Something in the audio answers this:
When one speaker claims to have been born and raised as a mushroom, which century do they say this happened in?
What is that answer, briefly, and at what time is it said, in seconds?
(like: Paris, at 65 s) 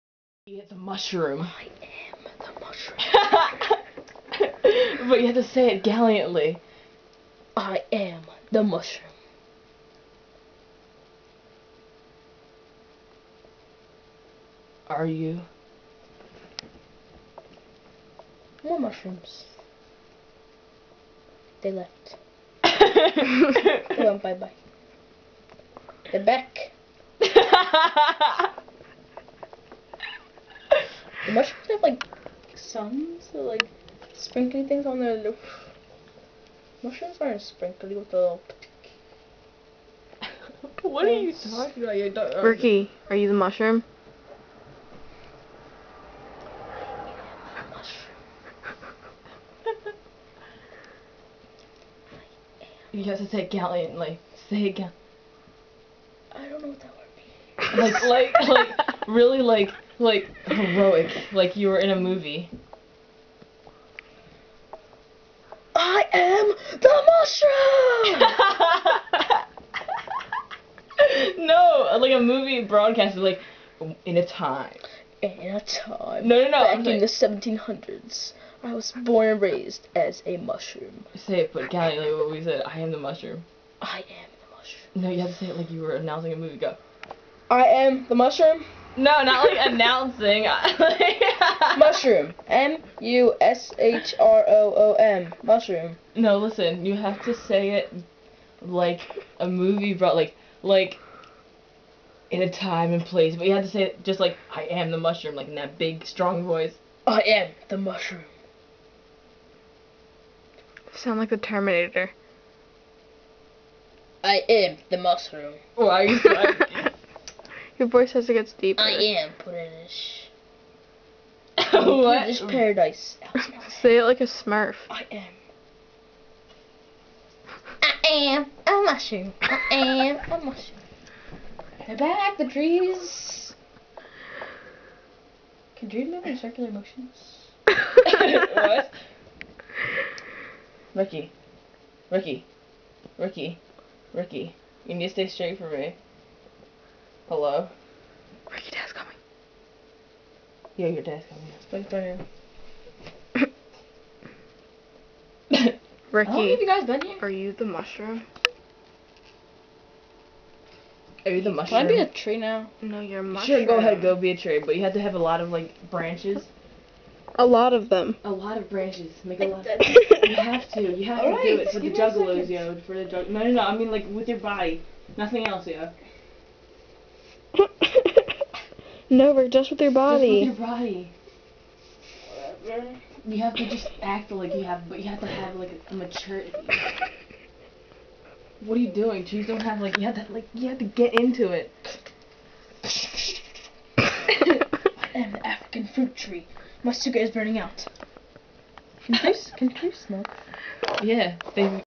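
1700s, at 77 s.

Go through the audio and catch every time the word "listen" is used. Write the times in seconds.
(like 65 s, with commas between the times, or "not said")
96 s.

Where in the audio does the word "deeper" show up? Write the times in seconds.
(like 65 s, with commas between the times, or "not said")
118 s.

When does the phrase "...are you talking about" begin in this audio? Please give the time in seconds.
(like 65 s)
41 s.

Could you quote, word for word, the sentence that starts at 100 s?
Like, like in a time and place.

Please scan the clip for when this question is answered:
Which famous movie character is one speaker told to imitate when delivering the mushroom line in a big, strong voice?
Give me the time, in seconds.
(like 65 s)
111 s.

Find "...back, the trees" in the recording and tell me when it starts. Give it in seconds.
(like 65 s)
131 s.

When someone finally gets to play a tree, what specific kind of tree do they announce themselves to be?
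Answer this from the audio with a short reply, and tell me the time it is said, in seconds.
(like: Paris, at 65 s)
African fruit tree, at 195 s.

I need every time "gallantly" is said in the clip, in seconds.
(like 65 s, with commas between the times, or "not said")
5 s, 53 s.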